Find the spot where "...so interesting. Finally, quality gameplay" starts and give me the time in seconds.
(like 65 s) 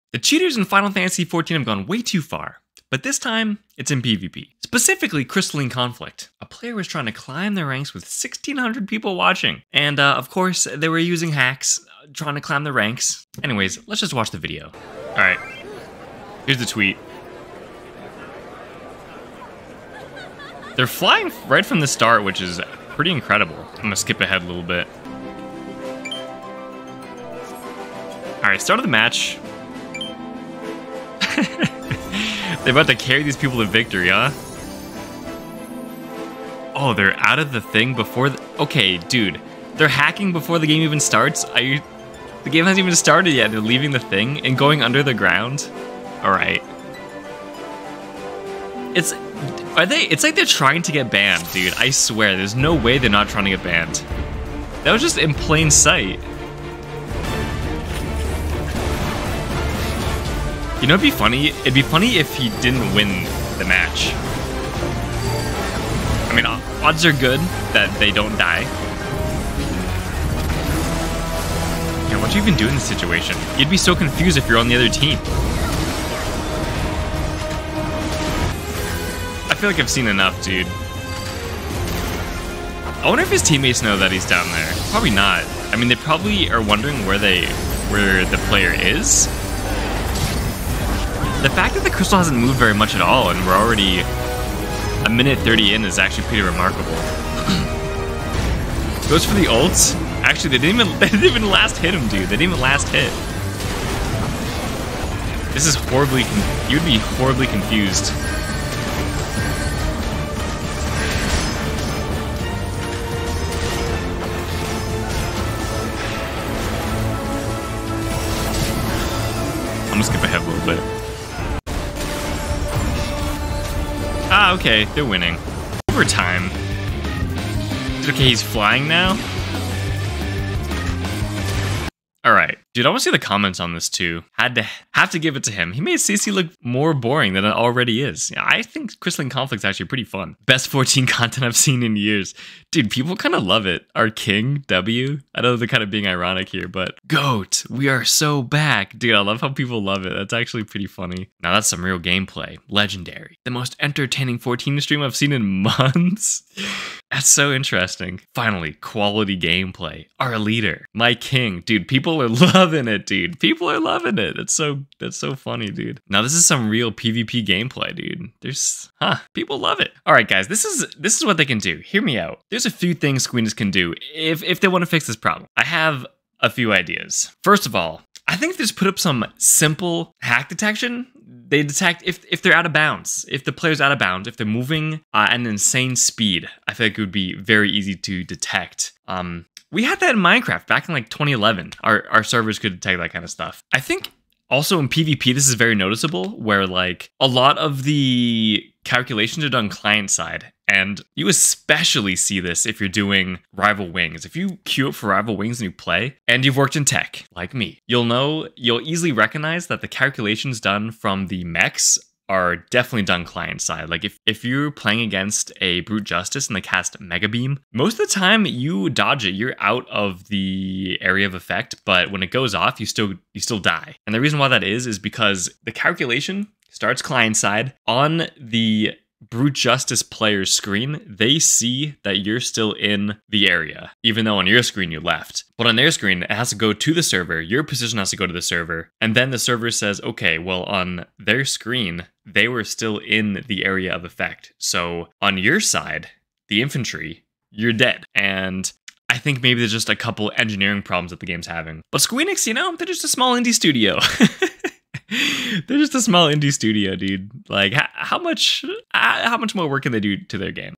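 157 s.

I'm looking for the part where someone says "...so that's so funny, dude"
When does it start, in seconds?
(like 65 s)
164 s.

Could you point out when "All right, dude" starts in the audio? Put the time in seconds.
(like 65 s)
132 s.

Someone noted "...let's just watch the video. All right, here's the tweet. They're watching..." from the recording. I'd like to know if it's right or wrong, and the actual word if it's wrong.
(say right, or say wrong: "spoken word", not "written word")
wrong: "flying", not "watching".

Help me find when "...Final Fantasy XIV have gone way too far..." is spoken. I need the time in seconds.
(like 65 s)
0 s.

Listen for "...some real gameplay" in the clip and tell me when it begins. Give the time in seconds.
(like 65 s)
151 s.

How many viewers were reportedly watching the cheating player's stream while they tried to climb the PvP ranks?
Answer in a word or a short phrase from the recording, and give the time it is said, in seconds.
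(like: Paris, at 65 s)
1,600, at 8 s.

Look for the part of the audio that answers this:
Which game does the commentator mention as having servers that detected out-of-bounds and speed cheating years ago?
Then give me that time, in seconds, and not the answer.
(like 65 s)
190 s.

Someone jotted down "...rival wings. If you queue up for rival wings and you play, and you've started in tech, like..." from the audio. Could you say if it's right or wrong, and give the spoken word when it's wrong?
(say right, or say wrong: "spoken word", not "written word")
wrong: "worked", not "started".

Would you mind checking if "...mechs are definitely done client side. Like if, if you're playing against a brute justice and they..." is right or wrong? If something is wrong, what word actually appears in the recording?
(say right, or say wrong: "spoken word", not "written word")
right.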